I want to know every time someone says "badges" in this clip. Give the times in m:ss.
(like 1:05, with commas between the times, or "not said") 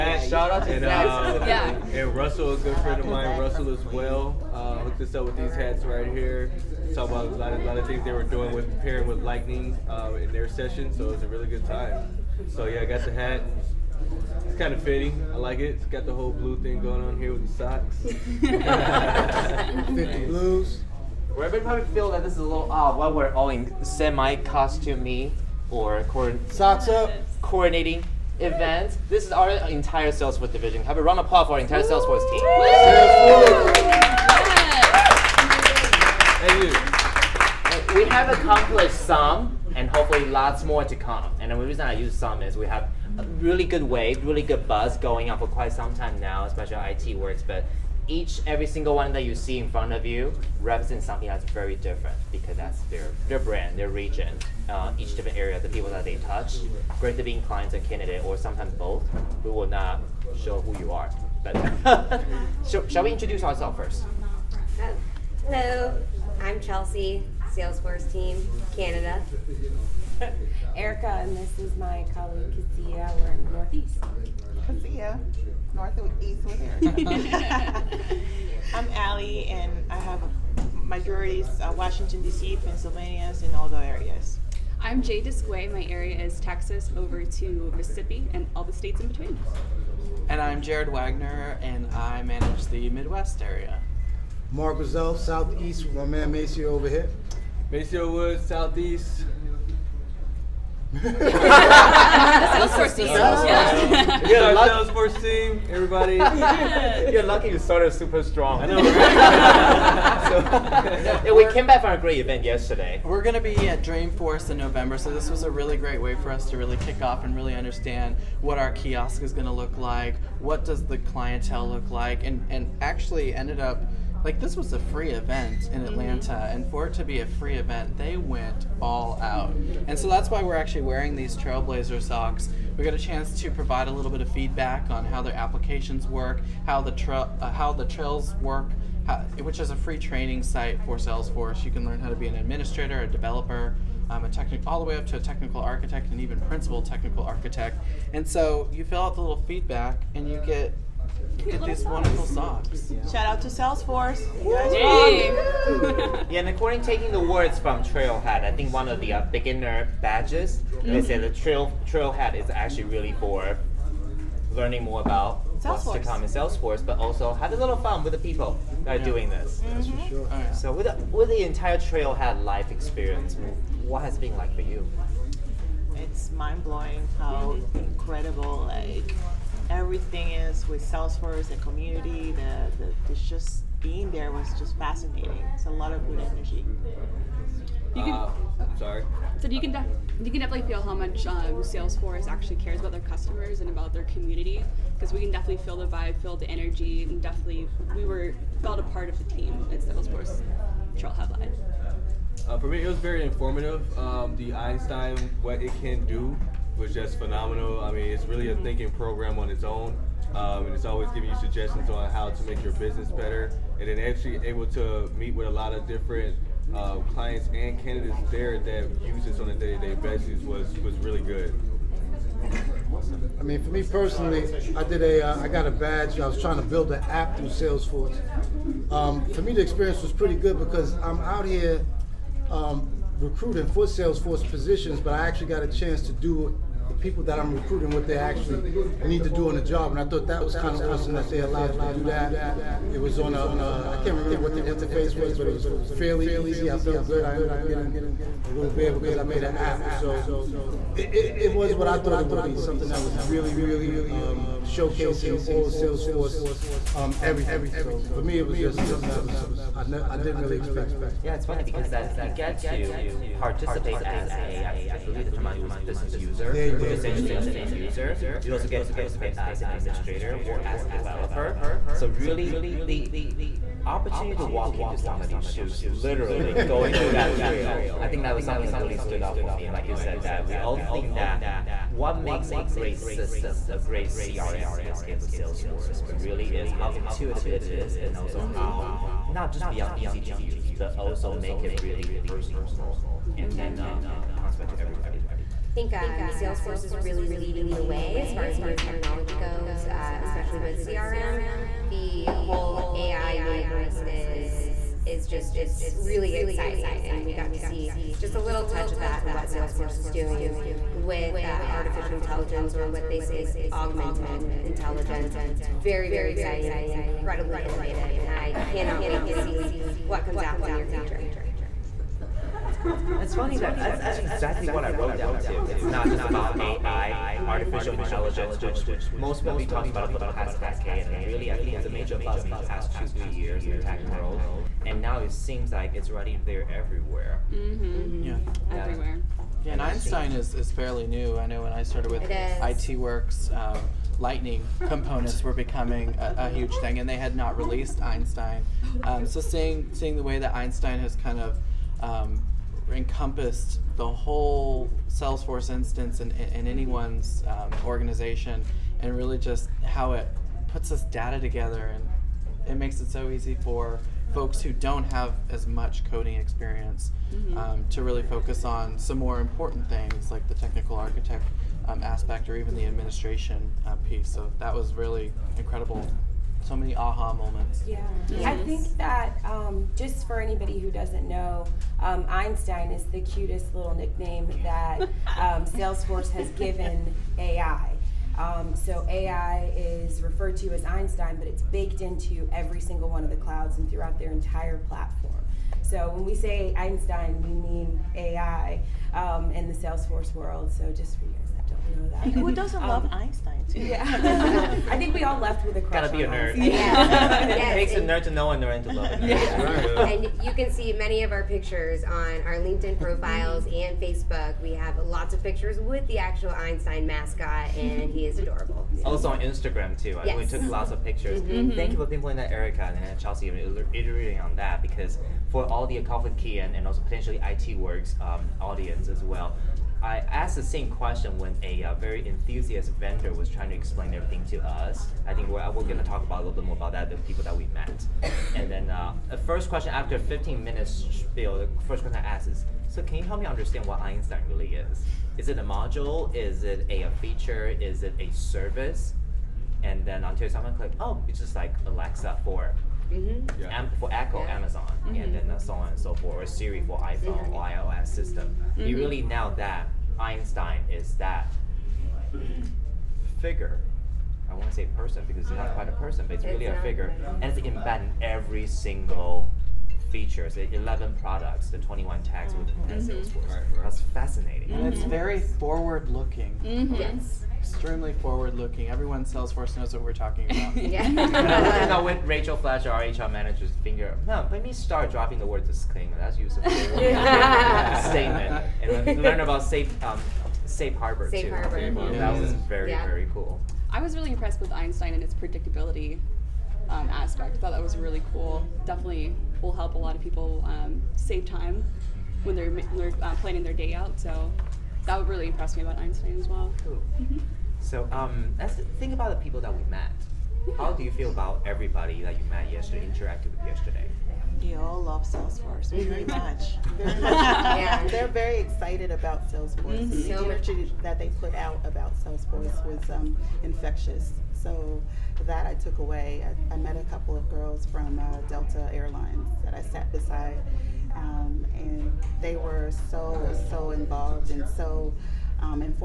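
2:40, 3:45.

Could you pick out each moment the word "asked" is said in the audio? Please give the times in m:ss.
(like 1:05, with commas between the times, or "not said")
7:10, 7:22.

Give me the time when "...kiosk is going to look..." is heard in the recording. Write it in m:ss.
1:58.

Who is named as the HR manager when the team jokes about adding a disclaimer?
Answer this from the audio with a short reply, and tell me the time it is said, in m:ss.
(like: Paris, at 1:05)
Rachel Fletcher, at 8:02.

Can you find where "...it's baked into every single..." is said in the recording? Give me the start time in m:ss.
6:31.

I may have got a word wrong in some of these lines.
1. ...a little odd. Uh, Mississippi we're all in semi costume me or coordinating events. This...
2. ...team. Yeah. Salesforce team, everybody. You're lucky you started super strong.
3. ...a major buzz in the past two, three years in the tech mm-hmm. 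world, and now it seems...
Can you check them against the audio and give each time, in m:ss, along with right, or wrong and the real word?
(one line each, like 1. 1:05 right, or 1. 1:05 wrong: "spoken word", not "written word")
1. 0:22 wrong: "Why", not "Mississippi"
2. 1:42 right
3. 5:31 right.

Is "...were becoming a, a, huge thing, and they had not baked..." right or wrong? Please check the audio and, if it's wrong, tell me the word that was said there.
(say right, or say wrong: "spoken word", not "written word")
wrong: "released", not "baked".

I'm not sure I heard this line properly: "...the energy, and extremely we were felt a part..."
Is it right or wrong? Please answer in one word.
wrong.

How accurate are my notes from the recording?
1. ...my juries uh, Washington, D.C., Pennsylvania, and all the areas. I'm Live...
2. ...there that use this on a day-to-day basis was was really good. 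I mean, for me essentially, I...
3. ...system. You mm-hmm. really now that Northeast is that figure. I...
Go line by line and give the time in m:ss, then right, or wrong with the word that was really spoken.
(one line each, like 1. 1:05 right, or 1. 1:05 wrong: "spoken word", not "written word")
1. 1:20 wrong: "Jade", not "Live"
2. 3:38 wrong: "personally", not "essentially"
3. 7:38 wrong: "Einstein", not "Northeast".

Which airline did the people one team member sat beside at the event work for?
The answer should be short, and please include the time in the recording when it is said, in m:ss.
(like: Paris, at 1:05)
Delta Airlines, at 8:48.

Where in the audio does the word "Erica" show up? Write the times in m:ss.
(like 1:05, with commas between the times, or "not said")
1:10, 7:02.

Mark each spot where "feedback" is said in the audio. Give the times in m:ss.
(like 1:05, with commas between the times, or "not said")
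2:14, 2:29.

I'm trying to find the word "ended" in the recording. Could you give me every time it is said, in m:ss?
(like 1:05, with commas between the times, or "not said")
2:03, 4:07.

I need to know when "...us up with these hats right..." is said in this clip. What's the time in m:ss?
0:05.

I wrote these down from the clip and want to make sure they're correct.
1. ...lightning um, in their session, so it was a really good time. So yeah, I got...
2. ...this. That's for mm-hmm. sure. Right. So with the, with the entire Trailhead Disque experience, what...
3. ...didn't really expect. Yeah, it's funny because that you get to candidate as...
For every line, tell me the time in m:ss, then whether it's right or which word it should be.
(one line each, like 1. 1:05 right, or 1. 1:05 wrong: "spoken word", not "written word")
1. 0:09 right
2. 2:49 wrong: "Live", not "Disque"
3. 4:20 wrong: "participate", not "candidate".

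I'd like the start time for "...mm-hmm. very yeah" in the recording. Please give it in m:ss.
8:12.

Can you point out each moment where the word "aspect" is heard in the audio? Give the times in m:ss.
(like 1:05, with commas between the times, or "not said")
6:12, 8:17.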